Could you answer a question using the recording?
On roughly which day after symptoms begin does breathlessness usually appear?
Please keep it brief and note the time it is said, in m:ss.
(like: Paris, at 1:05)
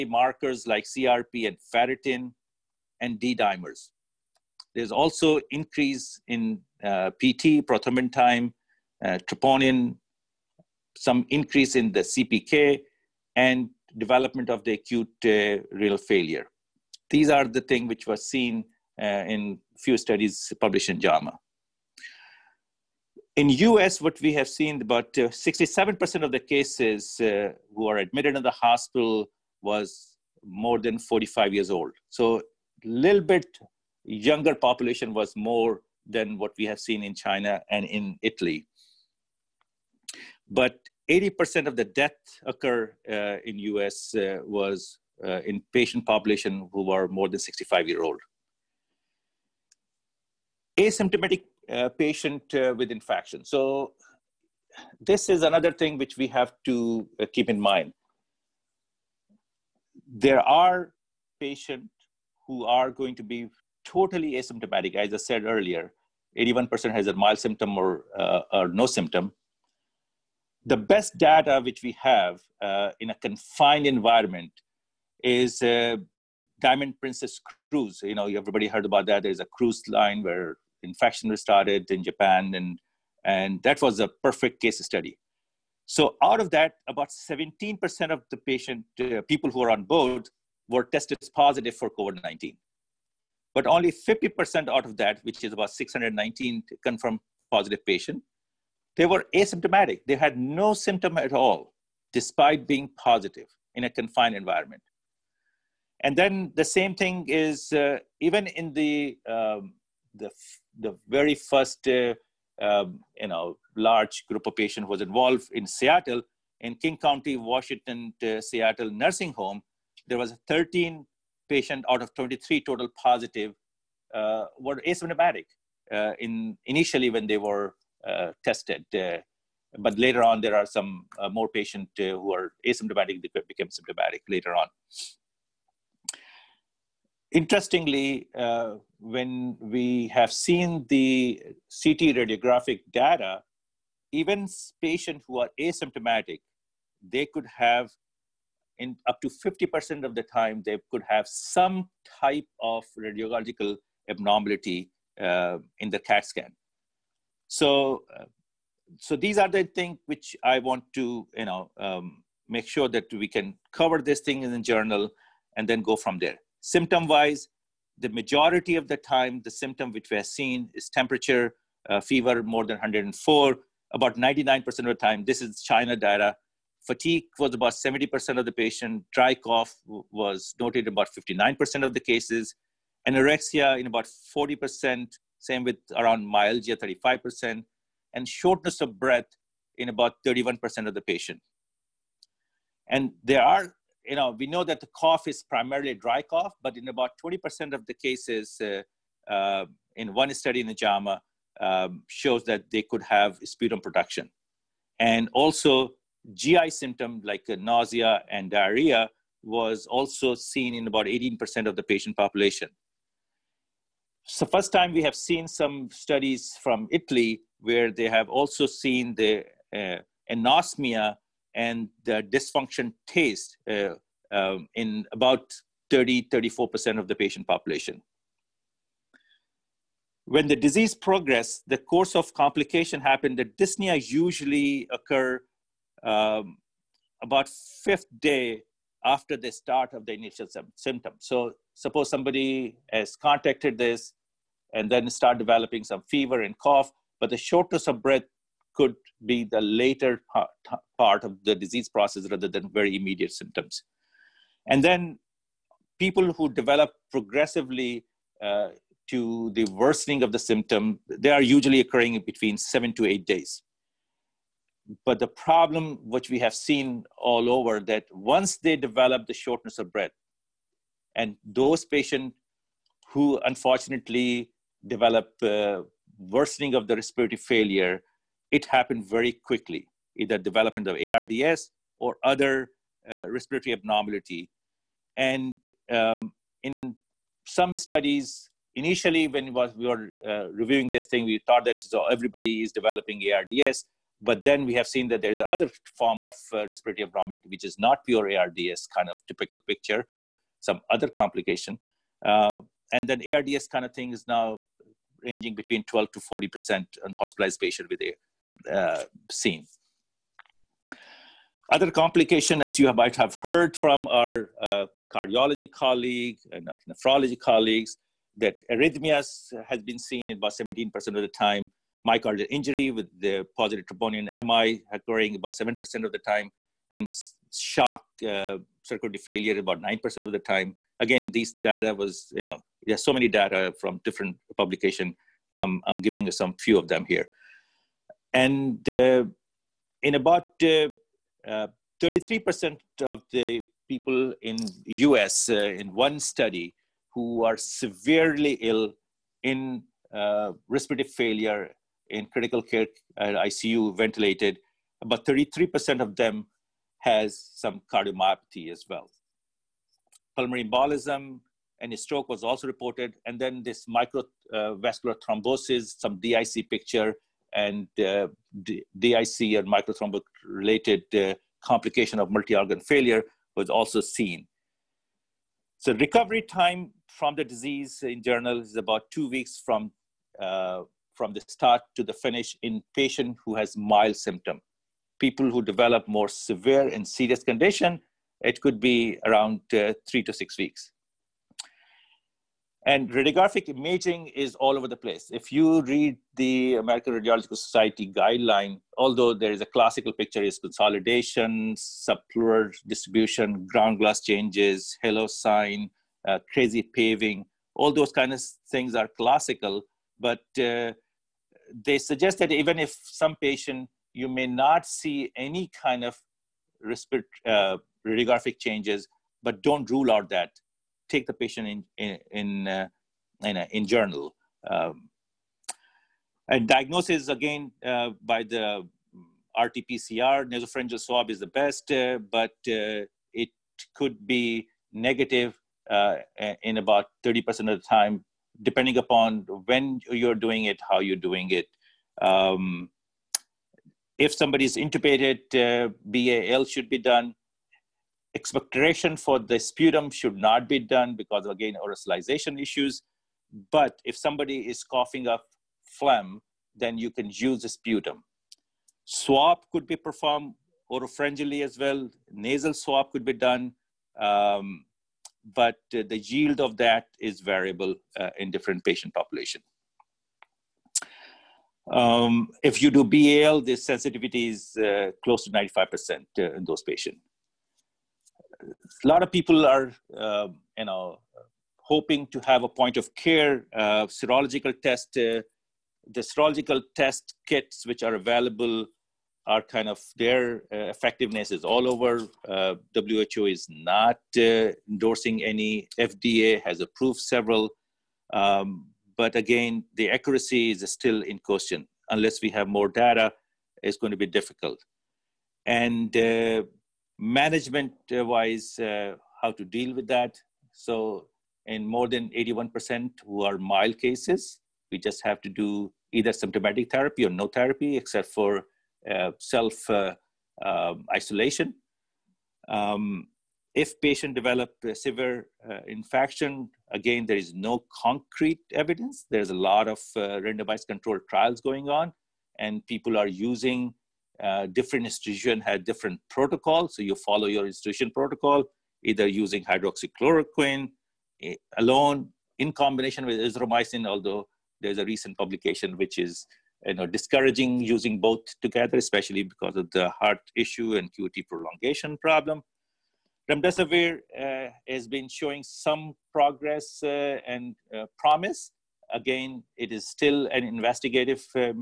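fifth day, at 3:57.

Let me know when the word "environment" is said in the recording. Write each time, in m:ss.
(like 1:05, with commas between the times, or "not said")
1:13, 1:44.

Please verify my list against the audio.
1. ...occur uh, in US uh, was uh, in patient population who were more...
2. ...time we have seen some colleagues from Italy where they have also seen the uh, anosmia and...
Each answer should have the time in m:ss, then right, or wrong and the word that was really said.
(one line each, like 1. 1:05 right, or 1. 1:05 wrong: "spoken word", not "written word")
1. 0:42 right
2. 3:34 wrong: "studies", not "colleagues".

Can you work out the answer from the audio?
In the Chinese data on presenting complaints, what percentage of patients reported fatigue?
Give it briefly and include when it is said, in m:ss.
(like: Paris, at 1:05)
70%, at 2:57.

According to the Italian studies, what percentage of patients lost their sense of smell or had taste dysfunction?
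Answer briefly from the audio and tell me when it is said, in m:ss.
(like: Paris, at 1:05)
34%, at 3:46.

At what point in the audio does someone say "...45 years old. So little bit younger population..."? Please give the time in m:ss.
0:30.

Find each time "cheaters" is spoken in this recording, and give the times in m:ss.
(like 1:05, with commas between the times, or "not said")
not said.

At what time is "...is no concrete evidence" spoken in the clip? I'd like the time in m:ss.
8:47.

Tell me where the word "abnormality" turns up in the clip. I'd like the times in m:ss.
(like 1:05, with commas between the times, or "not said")
2:34, 4:43, 4:57.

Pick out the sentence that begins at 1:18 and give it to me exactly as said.
You know, everybody heard about that.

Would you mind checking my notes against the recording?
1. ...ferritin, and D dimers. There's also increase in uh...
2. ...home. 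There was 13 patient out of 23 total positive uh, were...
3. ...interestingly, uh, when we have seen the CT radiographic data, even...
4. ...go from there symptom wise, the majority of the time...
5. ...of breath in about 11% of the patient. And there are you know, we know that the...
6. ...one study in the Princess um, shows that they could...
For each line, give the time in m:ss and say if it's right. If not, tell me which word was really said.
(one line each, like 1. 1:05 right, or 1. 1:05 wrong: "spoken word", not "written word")
1. 0:01 right
2. 1:59 right
3. 2:17 right
4. 2:45 right
5. 3:08 wrong: "31", not "11"
6. 3:20 wrong: "JAMA", not "Princess".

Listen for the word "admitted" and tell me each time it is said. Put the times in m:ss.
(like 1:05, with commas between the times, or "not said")
0:27.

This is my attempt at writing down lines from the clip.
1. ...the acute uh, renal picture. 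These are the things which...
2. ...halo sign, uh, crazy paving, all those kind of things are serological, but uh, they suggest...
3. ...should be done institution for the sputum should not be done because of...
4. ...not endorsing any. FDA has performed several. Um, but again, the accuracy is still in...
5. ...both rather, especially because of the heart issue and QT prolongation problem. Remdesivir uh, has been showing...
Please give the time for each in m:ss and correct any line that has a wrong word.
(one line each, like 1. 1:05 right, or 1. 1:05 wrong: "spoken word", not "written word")
1. 0:14 wrong: "failure", not "picture"
2. 6:45 wrong: "classical", not "serological"
3. 7:26 wrong: "expectoration", not "institution"
4. 8:13 wrong: "approved", not "performed"
5. 9:08 wrong: "together", not "rather".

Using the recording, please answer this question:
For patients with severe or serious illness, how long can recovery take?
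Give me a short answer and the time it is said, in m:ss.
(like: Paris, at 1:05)
three to six weeks, at 6:30.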